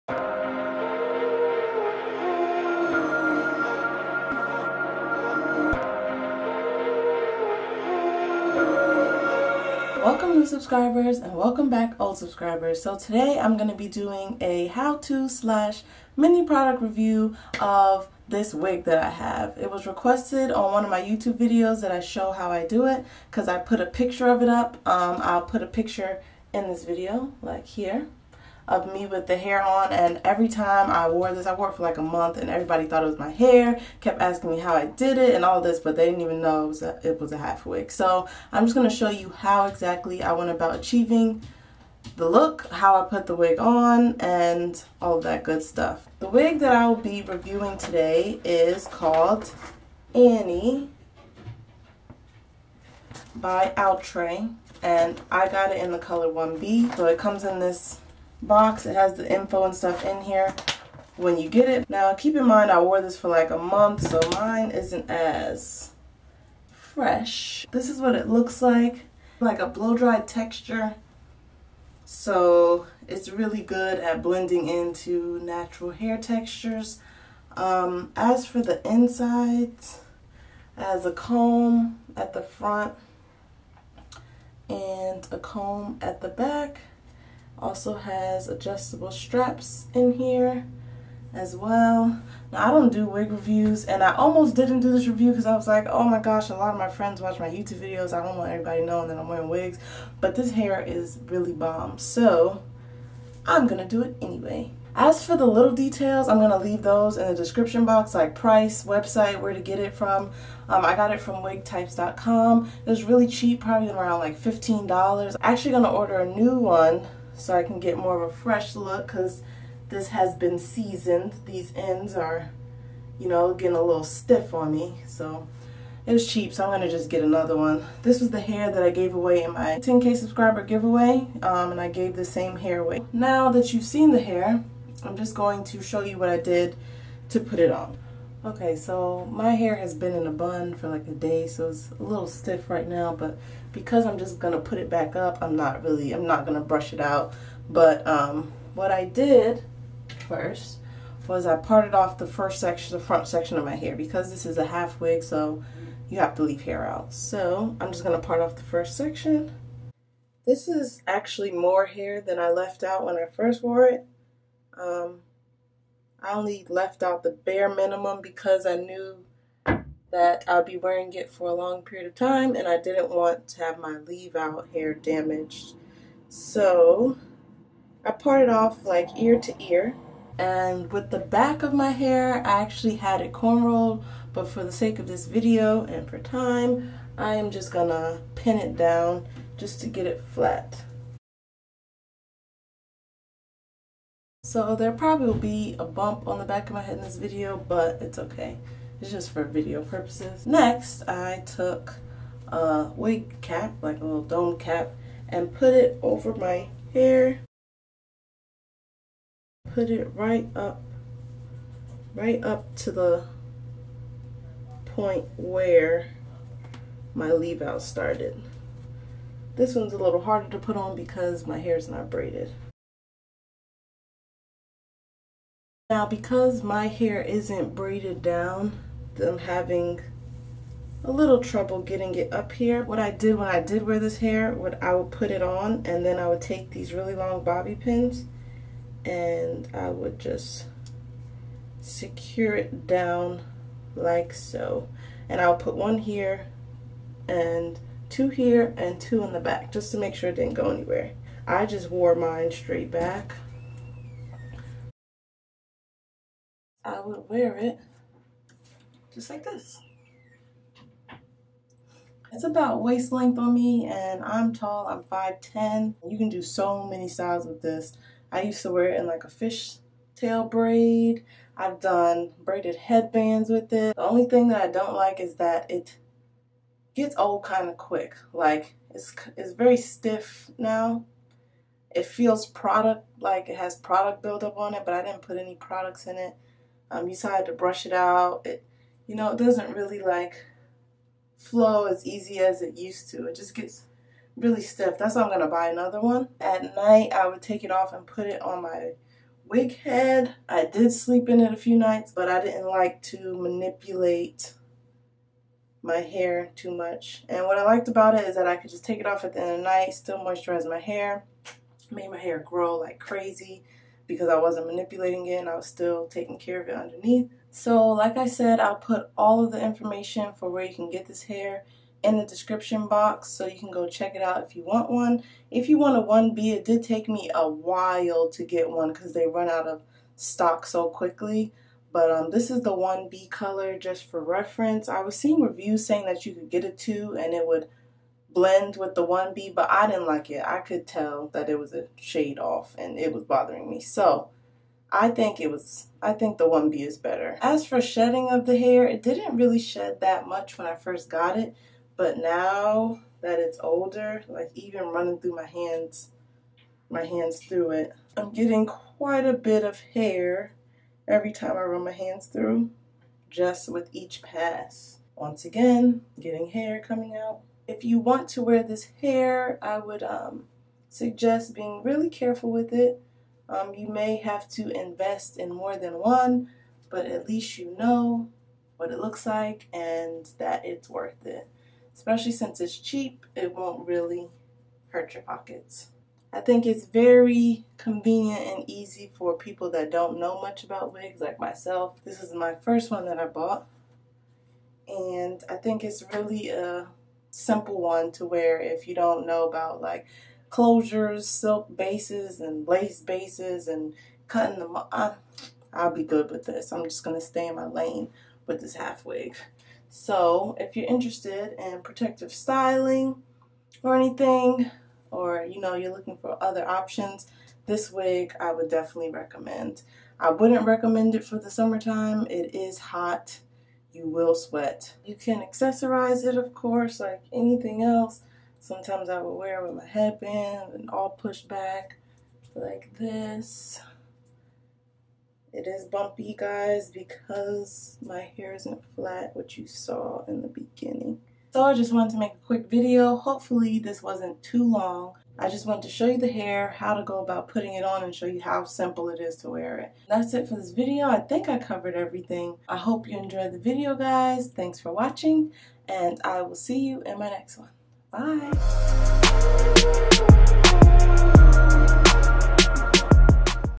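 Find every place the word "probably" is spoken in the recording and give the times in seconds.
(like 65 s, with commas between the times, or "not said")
113 s, 194 s.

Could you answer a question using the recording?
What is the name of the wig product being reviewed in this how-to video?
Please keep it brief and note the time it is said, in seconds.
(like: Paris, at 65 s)
Annie, at 50 s.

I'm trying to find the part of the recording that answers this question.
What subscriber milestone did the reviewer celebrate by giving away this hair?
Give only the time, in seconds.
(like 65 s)
129 s.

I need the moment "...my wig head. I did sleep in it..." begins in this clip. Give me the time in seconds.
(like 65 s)
298 s.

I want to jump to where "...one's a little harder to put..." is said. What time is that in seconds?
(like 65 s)
219 s.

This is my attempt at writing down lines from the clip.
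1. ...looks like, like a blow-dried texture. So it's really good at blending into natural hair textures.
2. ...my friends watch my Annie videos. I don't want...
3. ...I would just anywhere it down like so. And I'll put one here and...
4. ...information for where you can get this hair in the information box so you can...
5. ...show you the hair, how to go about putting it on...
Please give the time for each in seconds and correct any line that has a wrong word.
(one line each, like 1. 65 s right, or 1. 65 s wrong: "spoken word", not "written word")
1. 68 s right
2. 96 s wrong: "YouTube", not "Annie"
3. 239 s wrong: "secure", not "anywhere"
4. 319 s wrong: "description", not "information"
5. 445 s right.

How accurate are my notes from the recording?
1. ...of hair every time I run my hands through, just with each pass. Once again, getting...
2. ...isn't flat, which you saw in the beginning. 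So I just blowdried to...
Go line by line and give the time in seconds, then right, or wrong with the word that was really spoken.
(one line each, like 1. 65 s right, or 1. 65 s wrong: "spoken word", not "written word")
1. 359 s right
2. 438 s wrong: "wanted", not "blowdried".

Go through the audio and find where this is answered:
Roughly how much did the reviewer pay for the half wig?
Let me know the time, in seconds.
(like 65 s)
114 s.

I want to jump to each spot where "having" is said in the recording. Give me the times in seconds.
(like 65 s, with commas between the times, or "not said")
229 s.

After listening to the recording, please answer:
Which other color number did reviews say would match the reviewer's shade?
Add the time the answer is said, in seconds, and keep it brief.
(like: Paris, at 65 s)
2, at 336 s.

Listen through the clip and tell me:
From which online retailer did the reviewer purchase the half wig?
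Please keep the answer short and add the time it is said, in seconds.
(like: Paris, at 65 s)
wigtypes.com, at 111 s.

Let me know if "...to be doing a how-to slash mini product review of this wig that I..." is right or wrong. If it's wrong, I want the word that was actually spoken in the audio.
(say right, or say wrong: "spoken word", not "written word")
right.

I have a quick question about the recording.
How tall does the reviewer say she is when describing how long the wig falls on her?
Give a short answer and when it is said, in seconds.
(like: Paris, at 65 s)
5'10", at 265 s.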